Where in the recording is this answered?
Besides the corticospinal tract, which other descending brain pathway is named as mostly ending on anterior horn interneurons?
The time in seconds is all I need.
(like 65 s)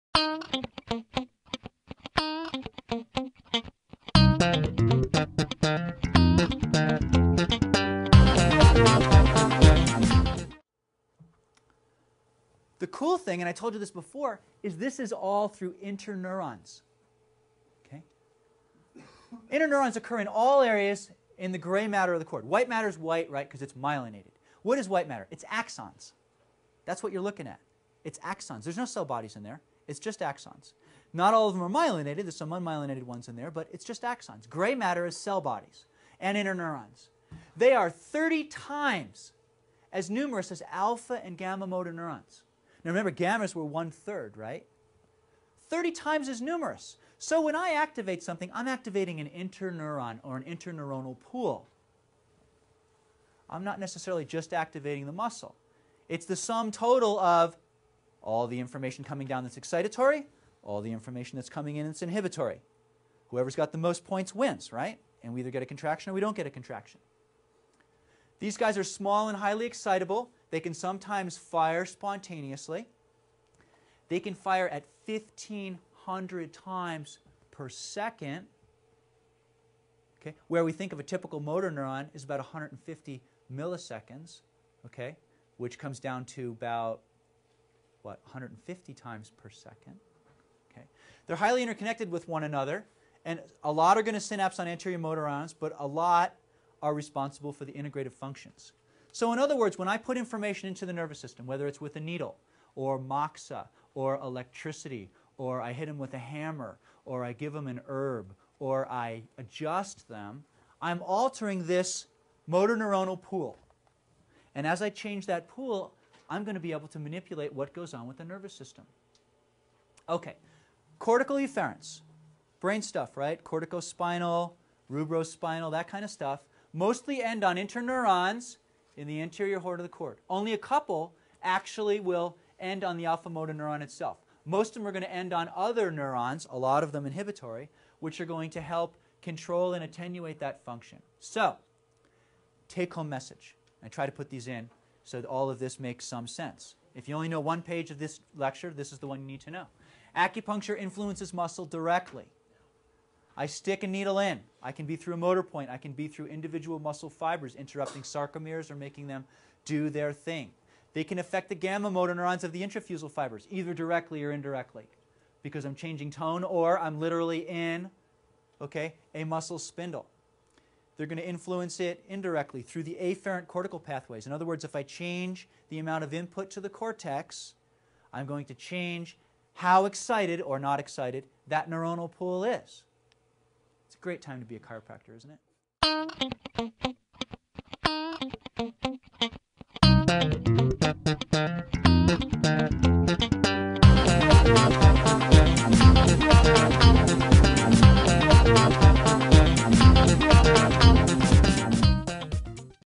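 124 s.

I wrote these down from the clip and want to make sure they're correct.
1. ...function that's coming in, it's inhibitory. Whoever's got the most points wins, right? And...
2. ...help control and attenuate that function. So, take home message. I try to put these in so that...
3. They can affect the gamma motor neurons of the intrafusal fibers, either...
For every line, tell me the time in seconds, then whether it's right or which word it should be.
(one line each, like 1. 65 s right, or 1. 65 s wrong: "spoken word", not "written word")
1. 60 s wrong: "information", not "function"
2. 138 s right
3. 160 s right.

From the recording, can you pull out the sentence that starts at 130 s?
Only a couple actually will end on the alpha motor neuron itself.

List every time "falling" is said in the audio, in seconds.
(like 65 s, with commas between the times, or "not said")
not said.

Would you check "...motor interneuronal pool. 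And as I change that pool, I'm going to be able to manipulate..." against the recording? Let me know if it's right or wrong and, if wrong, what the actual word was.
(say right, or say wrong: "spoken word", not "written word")
wrong: "neuronal", not "interneuronal".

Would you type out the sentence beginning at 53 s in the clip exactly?
I'm not necessarily just activating the muscle.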